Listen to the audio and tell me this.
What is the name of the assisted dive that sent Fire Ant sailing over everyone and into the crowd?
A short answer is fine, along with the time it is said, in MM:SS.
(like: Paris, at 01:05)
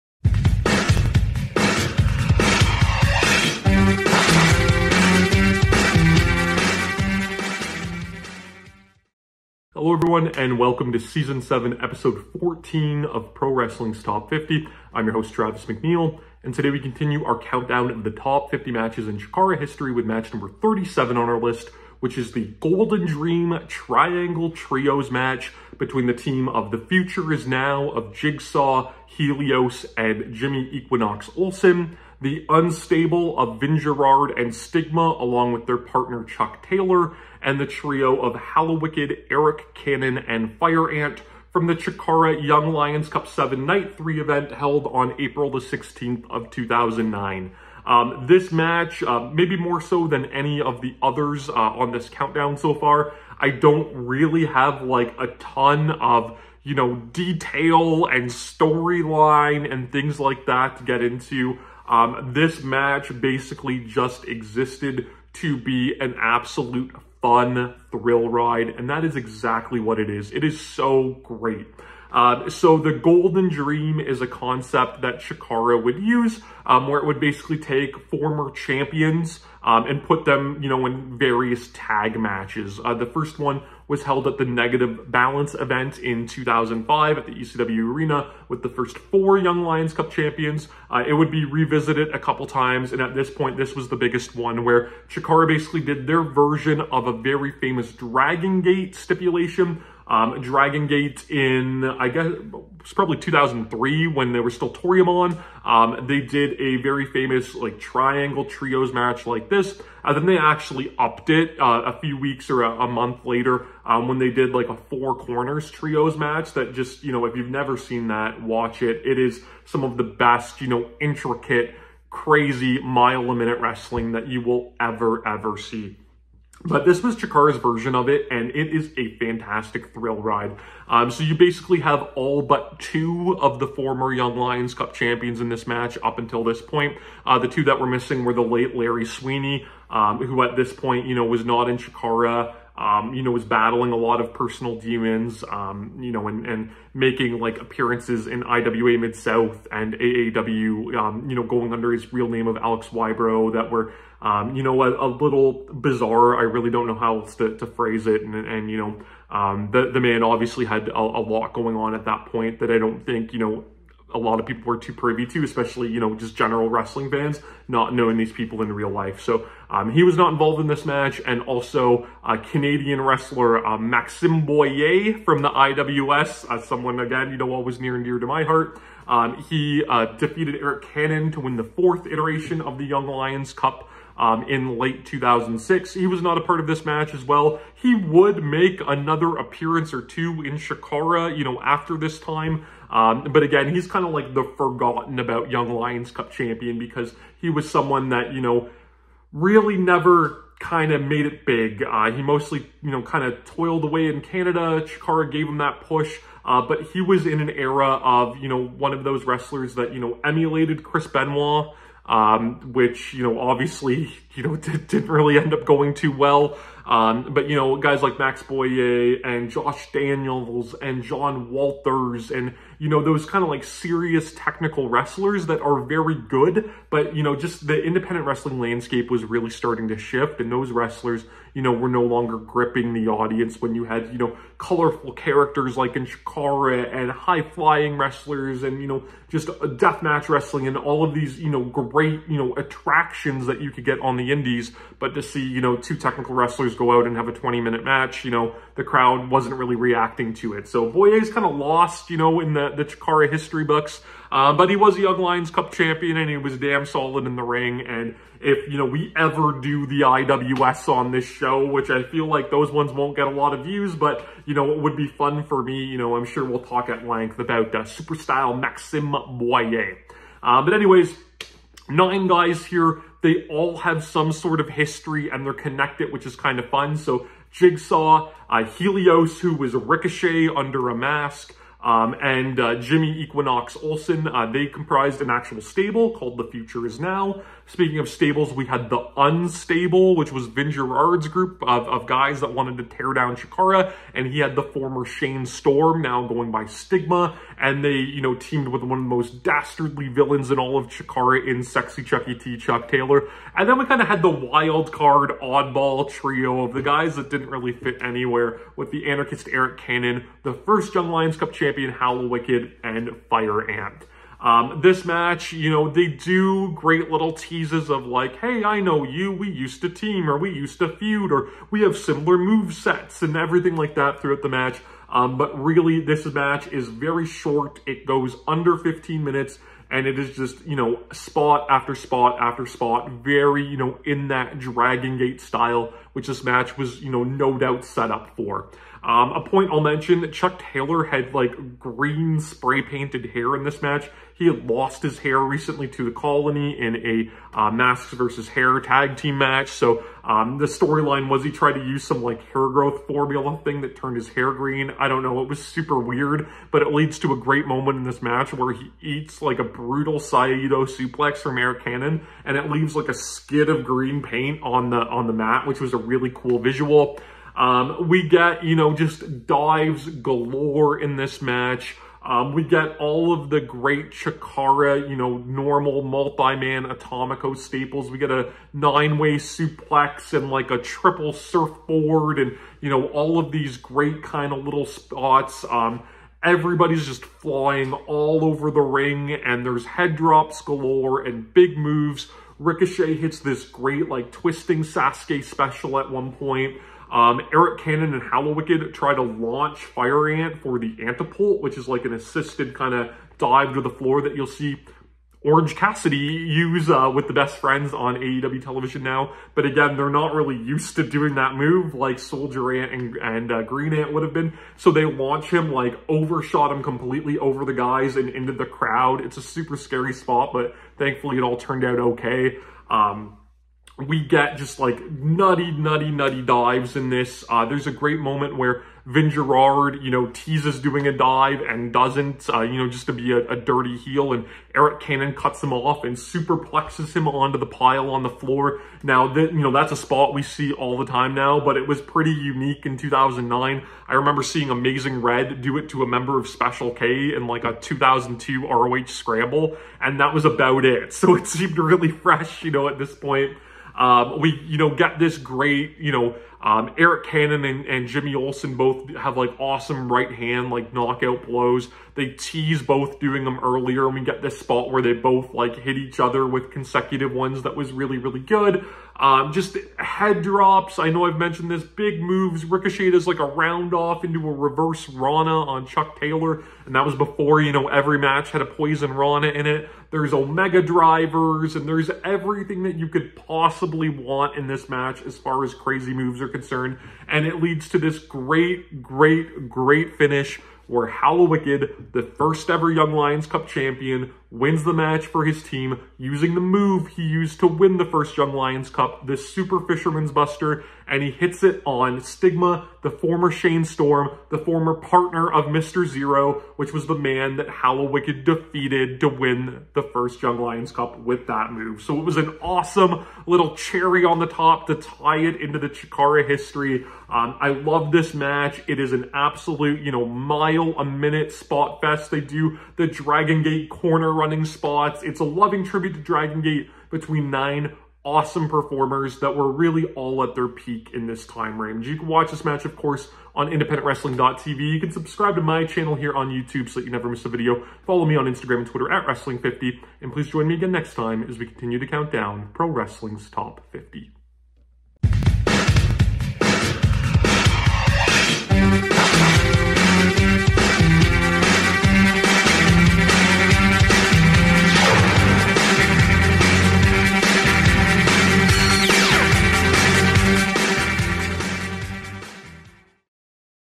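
Antipult, at 06:41.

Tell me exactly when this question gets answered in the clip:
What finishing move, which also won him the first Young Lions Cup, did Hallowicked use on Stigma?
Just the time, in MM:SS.
08:19.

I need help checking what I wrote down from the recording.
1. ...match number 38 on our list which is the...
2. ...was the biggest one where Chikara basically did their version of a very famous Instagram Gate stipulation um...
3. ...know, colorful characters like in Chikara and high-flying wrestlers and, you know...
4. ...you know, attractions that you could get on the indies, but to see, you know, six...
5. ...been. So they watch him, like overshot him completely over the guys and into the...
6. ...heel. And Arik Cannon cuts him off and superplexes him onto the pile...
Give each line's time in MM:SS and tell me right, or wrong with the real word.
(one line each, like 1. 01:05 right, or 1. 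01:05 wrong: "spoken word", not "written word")
1. 00:20 wrong: "37", not "38"
2. 01:33 wrong: "Dragon", not "Instagram"
3. 03:54 right
4. 04:02 wrong: "two", not "six"
5. 06:54 wrong: "launch", not "watch"
6. 07:13 right.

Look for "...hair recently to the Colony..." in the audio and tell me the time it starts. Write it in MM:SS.
05:45.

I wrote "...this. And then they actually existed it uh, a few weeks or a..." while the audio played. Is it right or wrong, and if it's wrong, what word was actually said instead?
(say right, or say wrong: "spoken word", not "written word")
wrong: "upped", not "existed".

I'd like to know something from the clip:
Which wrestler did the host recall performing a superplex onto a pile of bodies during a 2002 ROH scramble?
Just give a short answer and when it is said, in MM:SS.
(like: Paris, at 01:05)
Amazing Red, at 07:24.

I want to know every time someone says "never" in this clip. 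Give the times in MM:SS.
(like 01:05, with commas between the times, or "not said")
01:57, 03:19, 08:57.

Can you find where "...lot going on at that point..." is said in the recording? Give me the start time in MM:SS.
02:41.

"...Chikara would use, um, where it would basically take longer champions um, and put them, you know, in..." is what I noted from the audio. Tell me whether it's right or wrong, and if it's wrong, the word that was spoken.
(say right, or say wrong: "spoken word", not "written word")
wrong: "former", not "longer".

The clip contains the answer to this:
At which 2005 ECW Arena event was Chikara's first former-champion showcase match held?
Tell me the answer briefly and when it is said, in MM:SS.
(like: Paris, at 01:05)
Negative Balance, at 01:24.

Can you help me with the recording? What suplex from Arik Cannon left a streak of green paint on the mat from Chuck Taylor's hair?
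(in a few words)
Saito suplex.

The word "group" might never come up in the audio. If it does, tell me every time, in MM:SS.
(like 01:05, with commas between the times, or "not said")
04:51.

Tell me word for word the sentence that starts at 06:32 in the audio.
Ricochet hits this great, like, twisting Sasuke special at one point.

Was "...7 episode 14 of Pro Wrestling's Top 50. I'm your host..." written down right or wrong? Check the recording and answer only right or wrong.
right.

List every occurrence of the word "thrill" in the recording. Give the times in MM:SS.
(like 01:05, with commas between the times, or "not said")
01:07, 02:09.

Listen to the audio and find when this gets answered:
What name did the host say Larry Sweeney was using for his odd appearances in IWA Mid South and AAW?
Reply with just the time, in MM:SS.
02:32.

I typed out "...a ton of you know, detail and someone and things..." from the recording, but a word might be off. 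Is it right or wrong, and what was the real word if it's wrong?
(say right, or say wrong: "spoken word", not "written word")
wrong: "storyline", not "someone".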